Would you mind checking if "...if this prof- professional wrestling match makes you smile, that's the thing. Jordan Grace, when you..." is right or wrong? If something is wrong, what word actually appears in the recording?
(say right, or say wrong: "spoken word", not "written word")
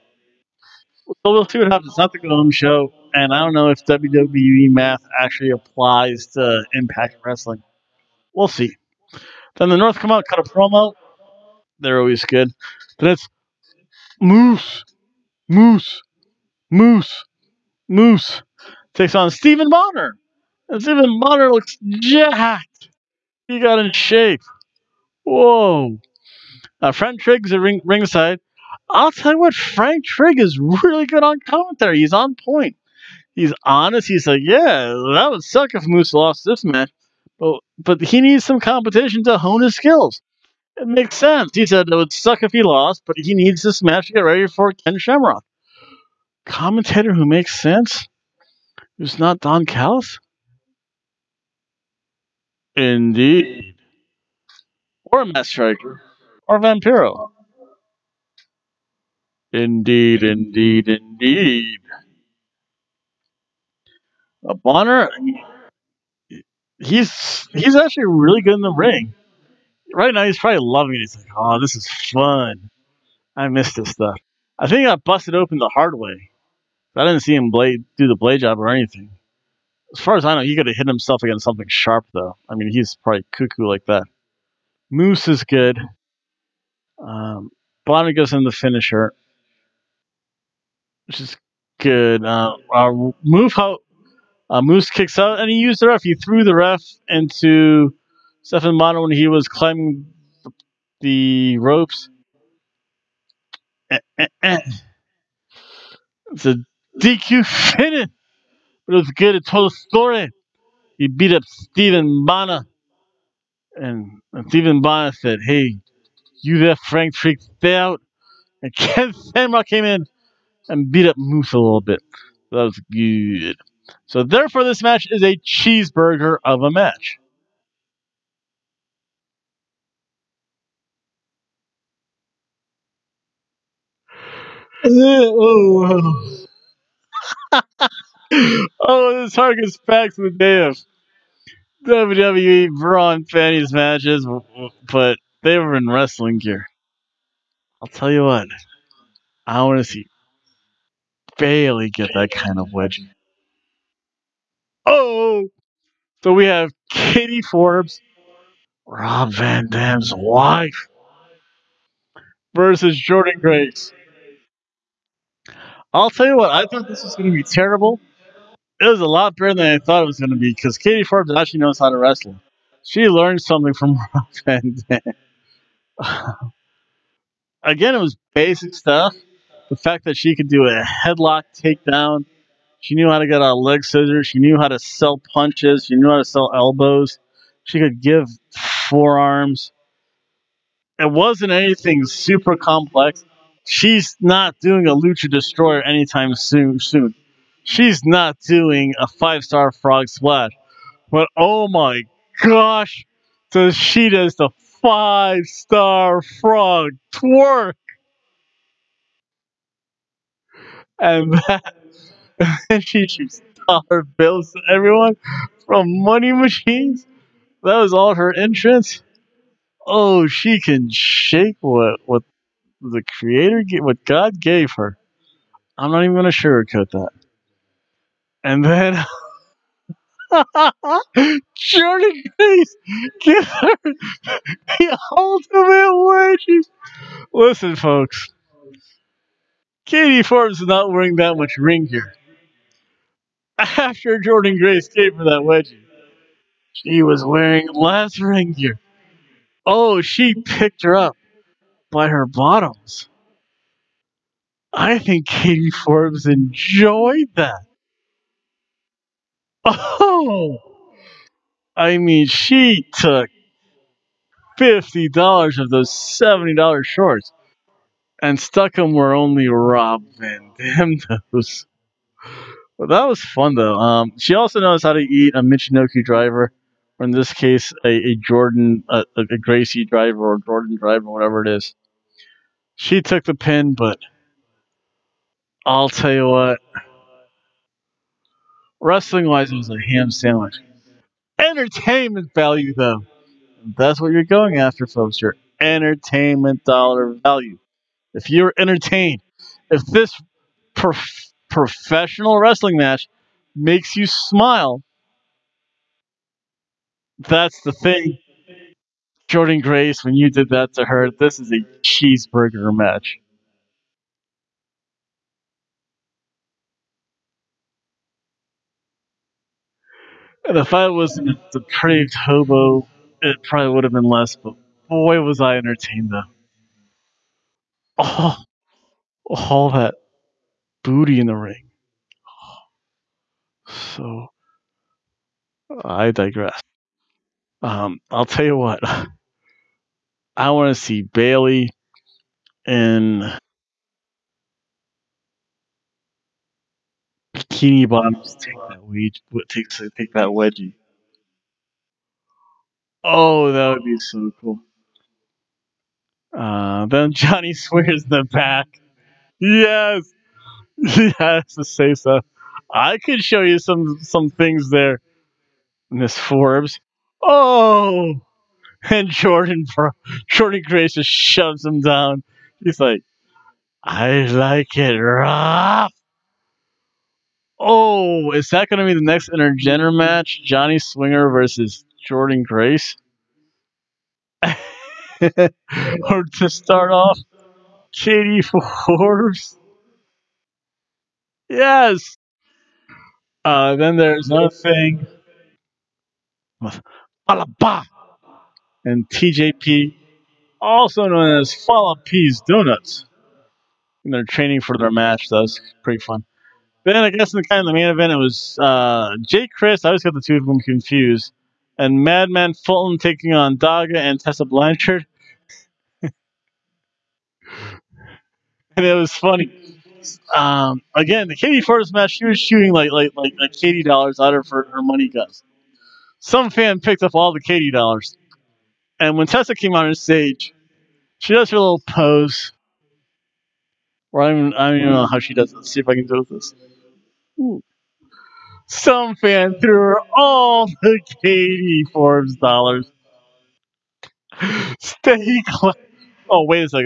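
right.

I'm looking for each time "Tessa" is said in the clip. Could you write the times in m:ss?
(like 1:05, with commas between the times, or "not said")
6:54, 7:09.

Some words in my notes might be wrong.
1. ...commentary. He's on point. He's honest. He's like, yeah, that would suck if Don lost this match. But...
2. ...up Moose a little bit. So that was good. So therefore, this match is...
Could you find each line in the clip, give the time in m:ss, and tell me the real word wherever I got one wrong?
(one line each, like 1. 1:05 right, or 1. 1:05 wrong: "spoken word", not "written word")
1. 0:31 wrong: "Moose", not "Don"
2. 2:01 right.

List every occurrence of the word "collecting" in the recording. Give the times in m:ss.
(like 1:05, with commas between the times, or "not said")
not said.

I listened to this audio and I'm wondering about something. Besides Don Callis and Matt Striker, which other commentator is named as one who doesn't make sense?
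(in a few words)
Vampiro.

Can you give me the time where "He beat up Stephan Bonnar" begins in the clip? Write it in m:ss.
1:50.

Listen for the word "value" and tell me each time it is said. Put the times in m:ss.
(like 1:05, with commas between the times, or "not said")
4:52, 4:57.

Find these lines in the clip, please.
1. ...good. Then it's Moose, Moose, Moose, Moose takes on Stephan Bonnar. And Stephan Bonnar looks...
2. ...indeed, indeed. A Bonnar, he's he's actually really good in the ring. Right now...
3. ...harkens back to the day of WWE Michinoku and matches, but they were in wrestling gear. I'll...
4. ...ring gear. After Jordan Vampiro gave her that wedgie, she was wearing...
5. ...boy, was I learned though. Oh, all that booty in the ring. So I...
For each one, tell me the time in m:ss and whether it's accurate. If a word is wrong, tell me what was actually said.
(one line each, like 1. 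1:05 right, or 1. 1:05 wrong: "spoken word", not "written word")
1. 0:12 right
2. 1:00 right
3. 2:19 wrong: "Braun", not "Michinoku"
4. 4:01 wrong: "Grace", not "Vampiro"
5. 5:24 wrong: "entertained", not "learned".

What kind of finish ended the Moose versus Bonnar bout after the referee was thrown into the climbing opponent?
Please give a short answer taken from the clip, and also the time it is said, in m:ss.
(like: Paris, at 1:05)
DQ, at 1:46.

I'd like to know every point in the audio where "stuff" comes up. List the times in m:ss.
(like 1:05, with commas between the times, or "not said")
1:13, 2:58.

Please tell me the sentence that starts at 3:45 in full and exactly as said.
I'm not even going to sugarcoat that.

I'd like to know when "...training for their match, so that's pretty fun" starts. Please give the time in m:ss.
6:44.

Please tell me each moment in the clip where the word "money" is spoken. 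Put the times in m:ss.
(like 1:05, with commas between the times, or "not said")
3:36, 7:04.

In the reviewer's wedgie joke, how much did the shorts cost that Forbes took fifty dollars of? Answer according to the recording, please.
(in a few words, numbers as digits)
70 dollars.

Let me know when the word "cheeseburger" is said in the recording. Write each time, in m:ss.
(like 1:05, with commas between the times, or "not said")
2:05, 5:11.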